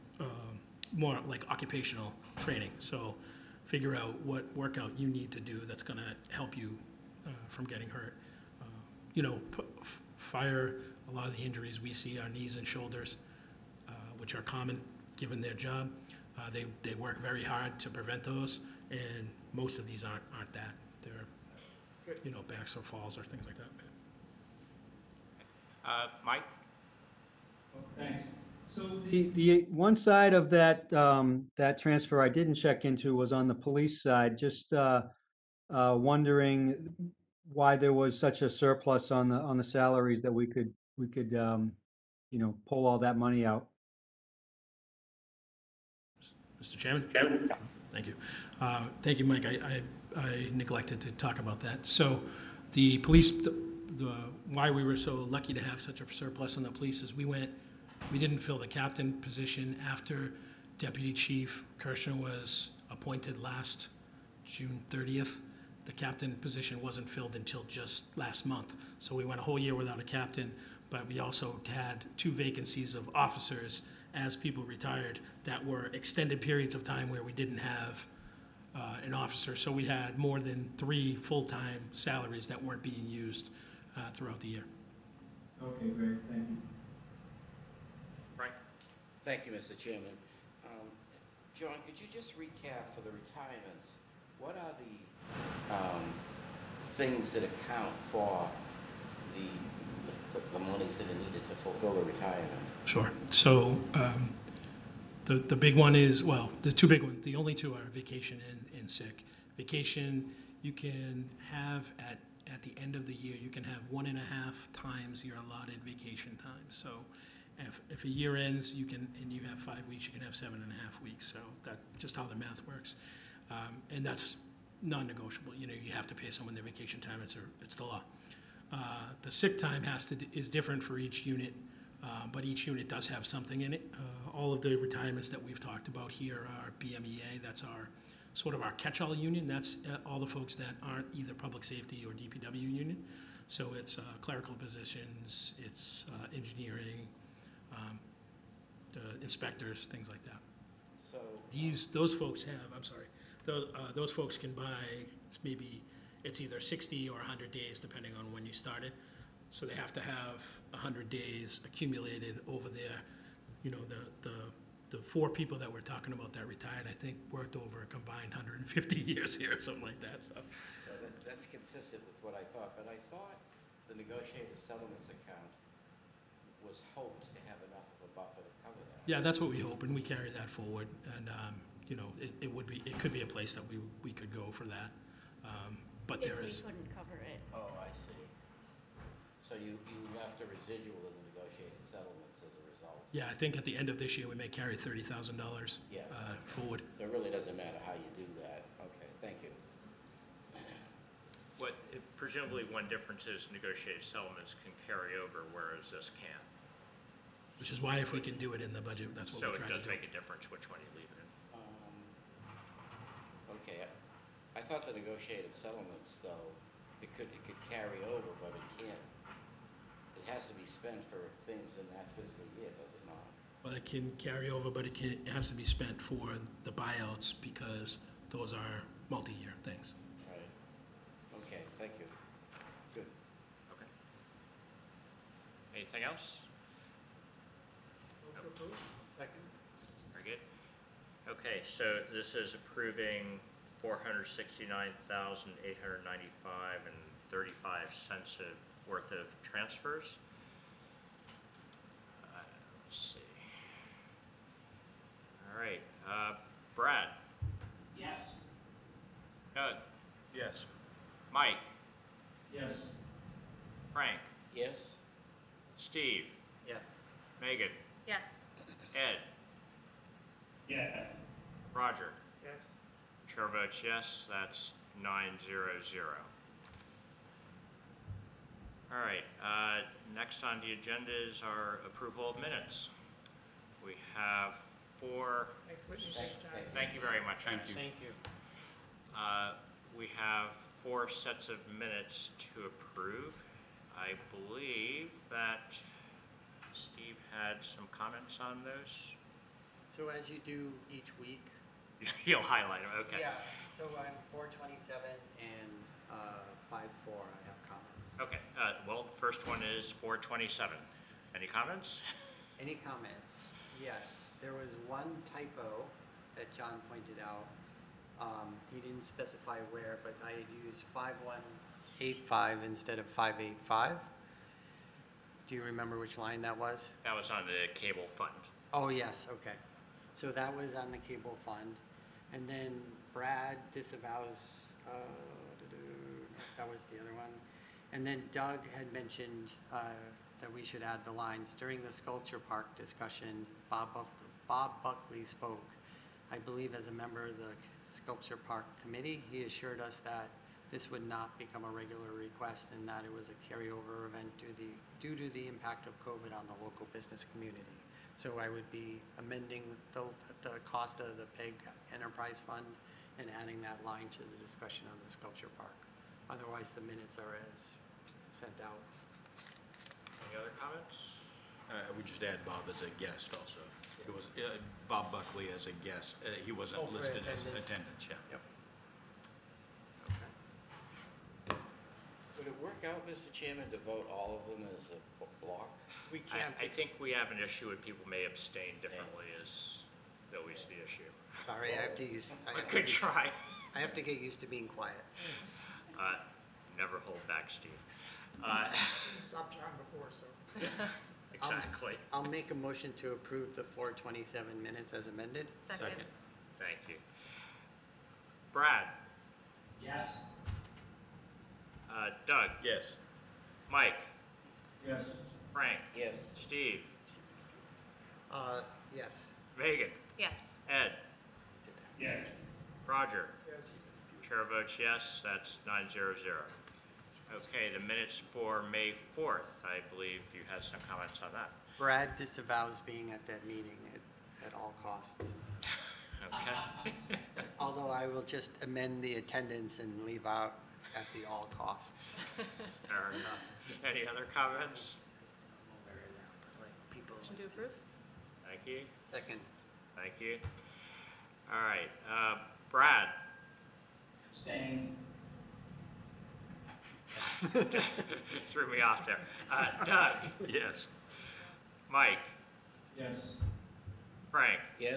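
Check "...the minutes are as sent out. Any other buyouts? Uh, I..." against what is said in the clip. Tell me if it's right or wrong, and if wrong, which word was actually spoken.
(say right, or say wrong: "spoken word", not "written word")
wrong: "comments", not "buyouts".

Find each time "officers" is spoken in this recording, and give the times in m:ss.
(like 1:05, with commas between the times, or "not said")
1:13, 1:19.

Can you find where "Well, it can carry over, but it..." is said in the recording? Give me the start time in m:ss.
3:43.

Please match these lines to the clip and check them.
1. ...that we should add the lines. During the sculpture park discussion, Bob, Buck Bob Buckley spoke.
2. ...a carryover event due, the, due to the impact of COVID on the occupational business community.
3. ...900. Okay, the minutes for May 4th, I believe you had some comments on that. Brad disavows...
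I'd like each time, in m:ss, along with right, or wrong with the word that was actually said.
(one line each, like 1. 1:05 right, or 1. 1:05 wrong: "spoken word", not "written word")
1. 5:40 right
2. 5:53 wrong: "local", not "occupational"
3. 7:05 right.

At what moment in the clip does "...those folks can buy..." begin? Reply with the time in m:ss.
2:33.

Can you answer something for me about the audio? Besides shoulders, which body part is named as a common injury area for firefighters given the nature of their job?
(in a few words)
Knees.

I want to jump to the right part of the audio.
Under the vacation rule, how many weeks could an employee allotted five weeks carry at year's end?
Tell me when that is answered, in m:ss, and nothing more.
2:00.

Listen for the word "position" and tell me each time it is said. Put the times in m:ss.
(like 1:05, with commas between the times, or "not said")
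0:59, 1:06, 2:24.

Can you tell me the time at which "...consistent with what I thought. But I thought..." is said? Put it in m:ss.
2:51.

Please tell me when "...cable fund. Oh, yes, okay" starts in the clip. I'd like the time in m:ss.
5:27.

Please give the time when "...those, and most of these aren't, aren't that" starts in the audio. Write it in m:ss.
0:18.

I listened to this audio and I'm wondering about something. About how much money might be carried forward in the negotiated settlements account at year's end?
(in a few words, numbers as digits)
$30,000.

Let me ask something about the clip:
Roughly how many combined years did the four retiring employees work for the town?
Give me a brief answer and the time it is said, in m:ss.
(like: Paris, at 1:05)
150 years, at 2:48.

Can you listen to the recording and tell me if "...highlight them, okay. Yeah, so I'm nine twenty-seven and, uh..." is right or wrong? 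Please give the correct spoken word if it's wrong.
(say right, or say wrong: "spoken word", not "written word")
wrong: "four", not "nine".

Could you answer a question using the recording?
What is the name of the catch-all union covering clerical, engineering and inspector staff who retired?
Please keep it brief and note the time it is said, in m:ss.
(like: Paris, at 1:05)
BMEA, at 2:16.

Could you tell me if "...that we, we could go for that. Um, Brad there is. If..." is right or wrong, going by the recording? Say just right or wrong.
wrong.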